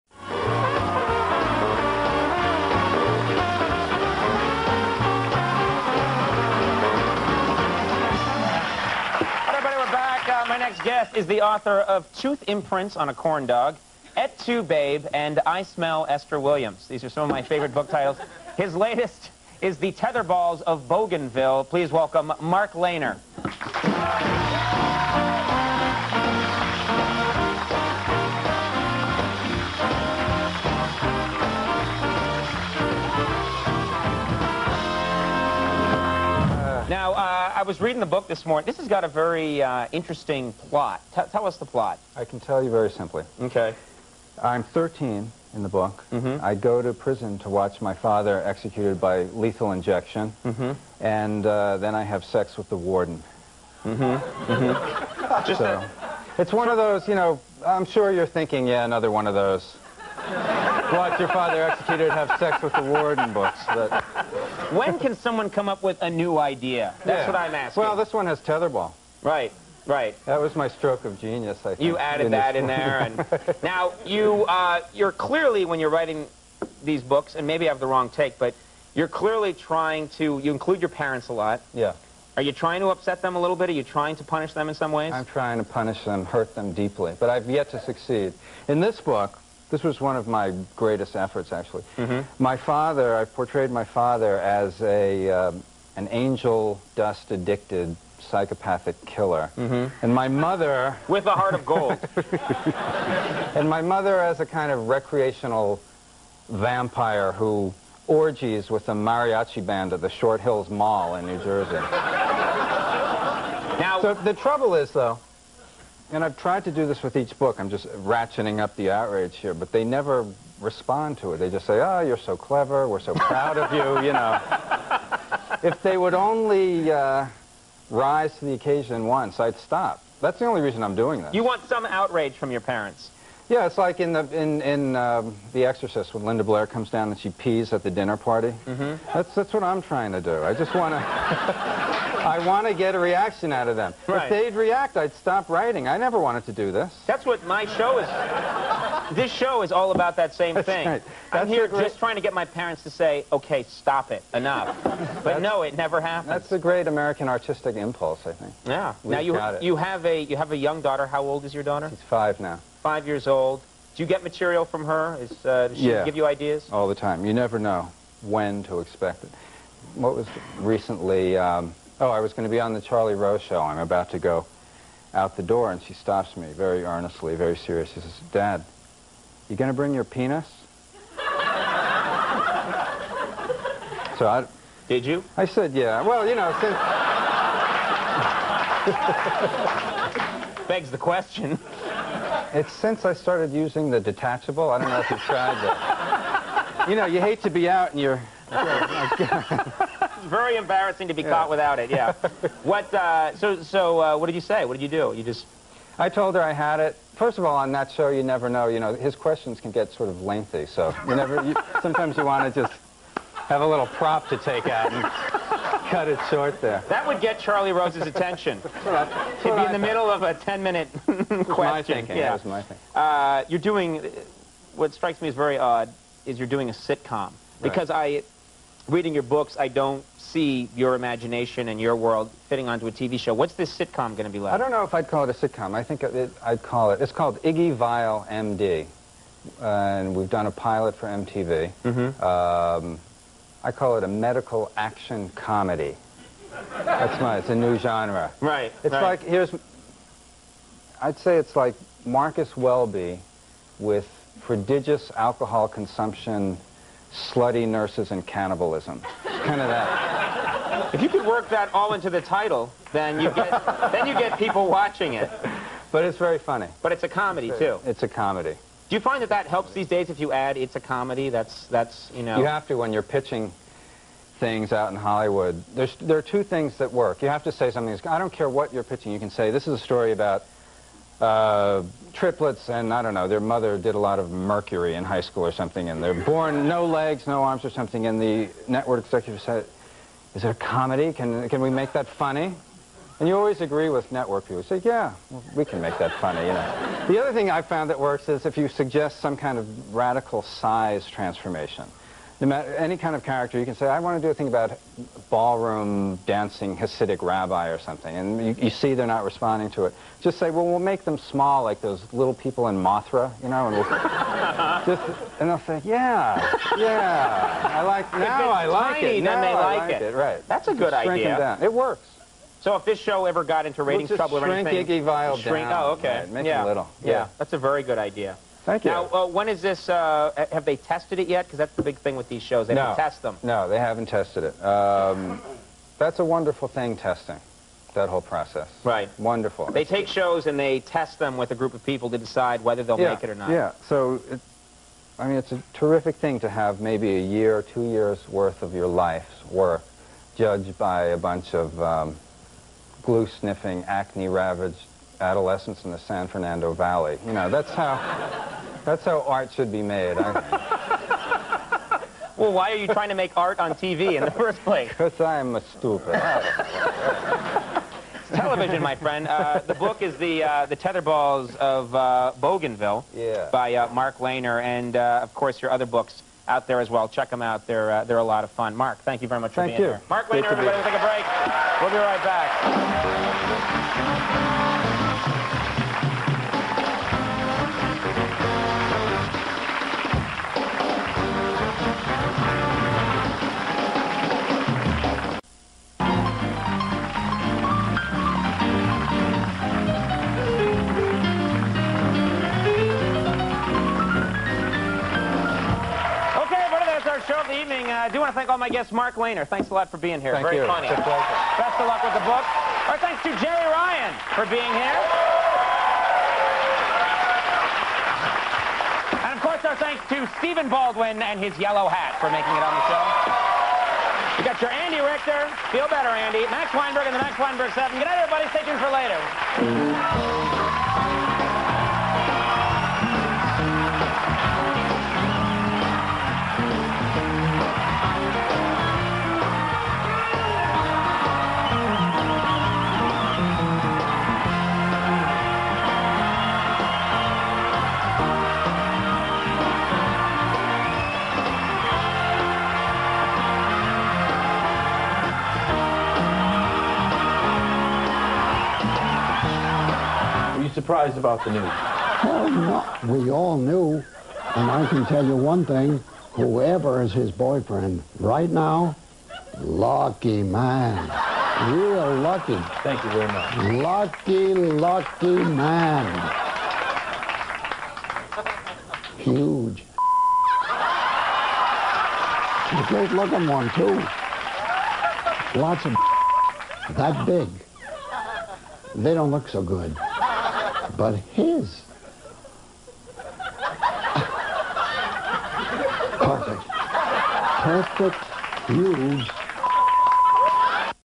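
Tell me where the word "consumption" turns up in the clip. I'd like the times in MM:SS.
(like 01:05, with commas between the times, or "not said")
04:15.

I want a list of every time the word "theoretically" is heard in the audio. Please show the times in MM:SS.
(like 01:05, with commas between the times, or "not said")
not said.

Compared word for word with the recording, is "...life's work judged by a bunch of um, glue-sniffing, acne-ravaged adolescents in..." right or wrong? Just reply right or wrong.
right.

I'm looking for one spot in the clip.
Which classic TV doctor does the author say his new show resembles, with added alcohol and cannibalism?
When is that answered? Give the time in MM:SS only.
04:12.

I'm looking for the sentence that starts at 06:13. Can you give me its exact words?
by uh, Mark Leyner, and uh, of course your other books out there as well.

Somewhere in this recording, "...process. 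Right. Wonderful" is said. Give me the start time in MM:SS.
05:38.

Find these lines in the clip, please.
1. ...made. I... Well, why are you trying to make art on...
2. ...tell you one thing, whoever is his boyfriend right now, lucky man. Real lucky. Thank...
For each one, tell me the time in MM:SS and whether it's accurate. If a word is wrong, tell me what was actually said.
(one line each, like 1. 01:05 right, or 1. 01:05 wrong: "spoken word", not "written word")
1. 05:59 right
2. 07:45 right.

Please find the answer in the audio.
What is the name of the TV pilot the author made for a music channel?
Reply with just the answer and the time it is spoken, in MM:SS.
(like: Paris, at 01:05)
Iggy Vile MD, at 03:57.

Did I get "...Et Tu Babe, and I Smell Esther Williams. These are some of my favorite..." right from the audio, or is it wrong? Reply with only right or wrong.
right.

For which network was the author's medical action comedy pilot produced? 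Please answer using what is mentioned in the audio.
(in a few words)
MTV.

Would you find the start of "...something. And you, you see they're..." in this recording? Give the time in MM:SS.
05:07.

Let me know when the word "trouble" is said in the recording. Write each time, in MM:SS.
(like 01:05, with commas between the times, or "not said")
01:54, 05:24.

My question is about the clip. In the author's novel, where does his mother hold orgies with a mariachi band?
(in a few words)
Short Hills Mall.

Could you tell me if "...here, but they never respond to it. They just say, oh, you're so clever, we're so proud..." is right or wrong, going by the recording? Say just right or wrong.
right.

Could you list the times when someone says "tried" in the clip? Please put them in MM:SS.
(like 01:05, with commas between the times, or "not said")
01:56, 03:15.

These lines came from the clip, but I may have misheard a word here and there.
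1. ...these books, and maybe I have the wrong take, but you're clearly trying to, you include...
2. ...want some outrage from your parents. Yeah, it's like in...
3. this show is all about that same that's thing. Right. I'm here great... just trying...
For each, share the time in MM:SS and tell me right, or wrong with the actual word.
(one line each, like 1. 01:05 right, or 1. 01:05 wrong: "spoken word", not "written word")
1. 01:16 right
2. 02:11 right
3. 02:29 right.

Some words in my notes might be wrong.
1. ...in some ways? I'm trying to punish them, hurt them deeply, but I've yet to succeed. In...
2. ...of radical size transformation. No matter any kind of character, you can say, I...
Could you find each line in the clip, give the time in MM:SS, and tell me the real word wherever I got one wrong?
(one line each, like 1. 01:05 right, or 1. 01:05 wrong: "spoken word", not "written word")
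1. 01:24 right
2. 04:59 right.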